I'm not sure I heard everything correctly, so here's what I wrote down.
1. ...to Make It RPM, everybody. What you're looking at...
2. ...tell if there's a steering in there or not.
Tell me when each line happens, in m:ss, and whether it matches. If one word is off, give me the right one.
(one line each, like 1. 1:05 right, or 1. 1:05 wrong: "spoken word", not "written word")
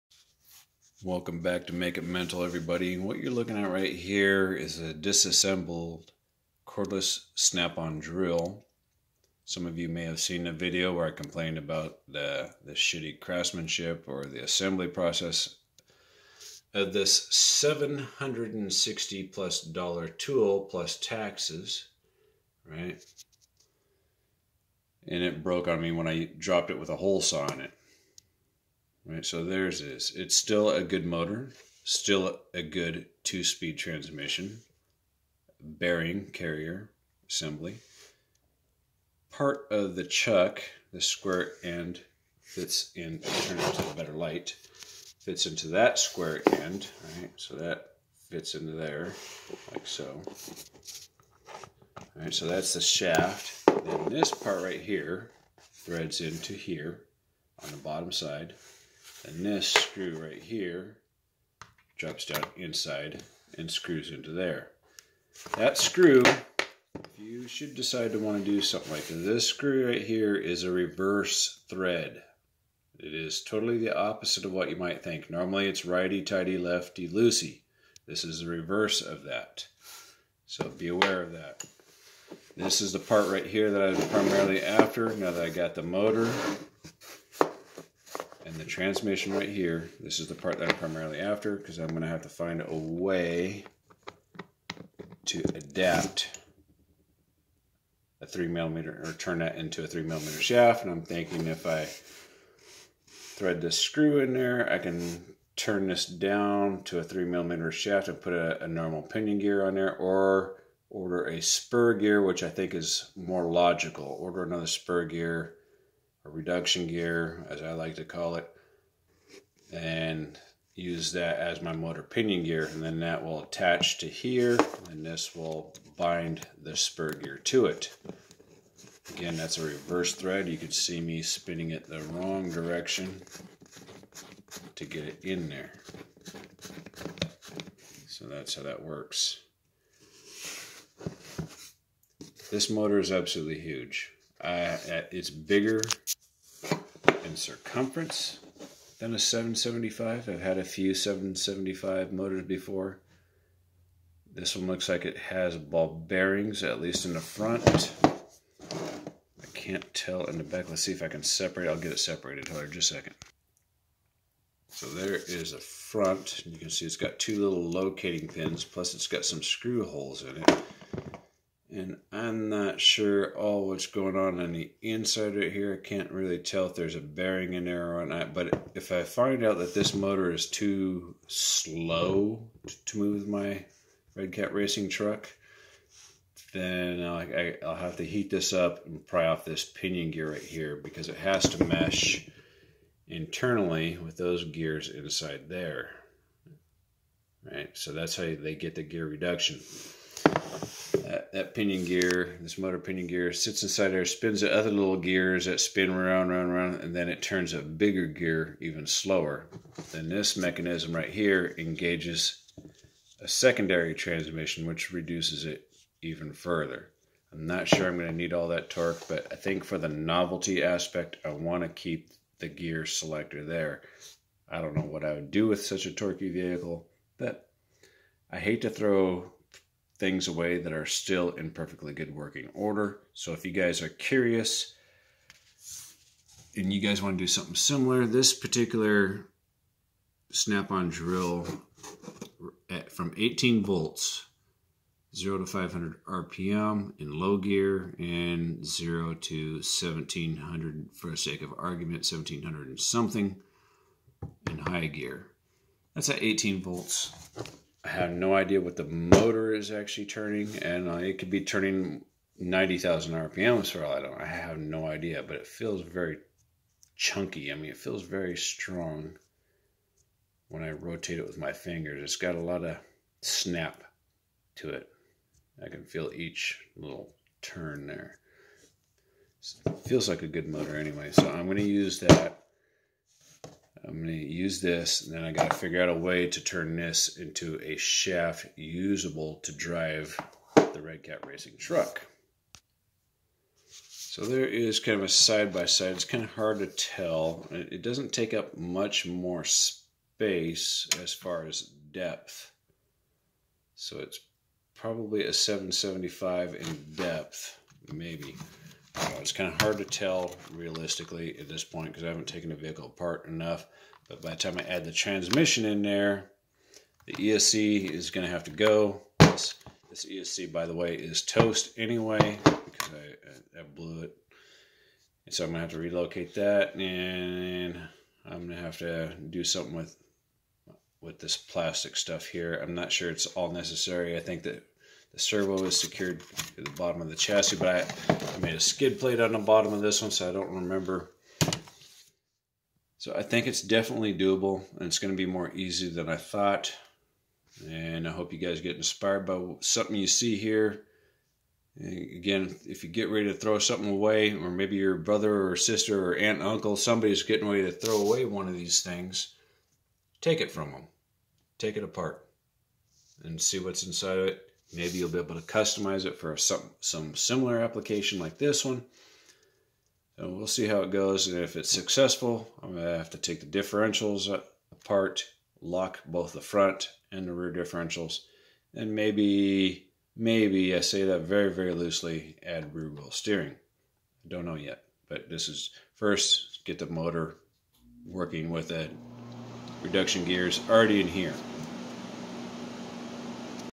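1. 0:01 wrong: "Mental", not "RPM"
2. 2:56 wrong: "bearing", not "steering".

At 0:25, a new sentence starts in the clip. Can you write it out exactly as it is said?
And it broke on me when I dropped it with a hole saw in it right?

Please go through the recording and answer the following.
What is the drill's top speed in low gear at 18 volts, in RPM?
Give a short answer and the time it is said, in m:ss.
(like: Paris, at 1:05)
500 RPM, at 4:05.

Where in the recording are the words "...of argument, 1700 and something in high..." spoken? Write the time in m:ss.
4:11.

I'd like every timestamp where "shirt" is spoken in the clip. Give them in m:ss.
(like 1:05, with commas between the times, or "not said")
not said.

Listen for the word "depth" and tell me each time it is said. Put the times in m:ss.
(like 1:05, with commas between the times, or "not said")
5:01, 5:06.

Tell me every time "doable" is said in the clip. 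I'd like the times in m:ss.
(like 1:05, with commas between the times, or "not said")
5:44.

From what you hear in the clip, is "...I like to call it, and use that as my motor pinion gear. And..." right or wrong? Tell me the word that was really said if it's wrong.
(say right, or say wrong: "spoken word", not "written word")
right.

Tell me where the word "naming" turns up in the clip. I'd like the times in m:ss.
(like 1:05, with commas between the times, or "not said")
not said.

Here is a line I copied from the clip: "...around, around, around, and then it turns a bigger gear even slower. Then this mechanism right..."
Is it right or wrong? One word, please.
right.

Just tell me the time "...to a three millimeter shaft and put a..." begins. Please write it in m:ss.
1:46.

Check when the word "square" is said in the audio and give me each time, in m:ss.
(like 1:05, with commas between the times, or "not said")
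0:41, 0:45.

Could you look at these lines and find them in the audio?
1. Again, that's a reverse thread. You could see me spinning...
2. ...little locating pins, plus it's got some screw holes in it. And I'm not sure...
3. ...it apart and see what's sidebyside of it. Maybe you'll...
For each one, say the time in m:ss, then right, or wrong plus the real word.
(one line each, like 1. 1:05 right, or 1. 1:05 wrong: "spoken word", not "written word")
1. 2:09 right
2. 2:47 right
3. 6:01 wrong: "inside", not "sidebyside".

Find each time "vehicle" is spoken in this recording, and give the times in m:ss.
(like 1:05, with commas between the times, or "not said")
3:46, 5:12.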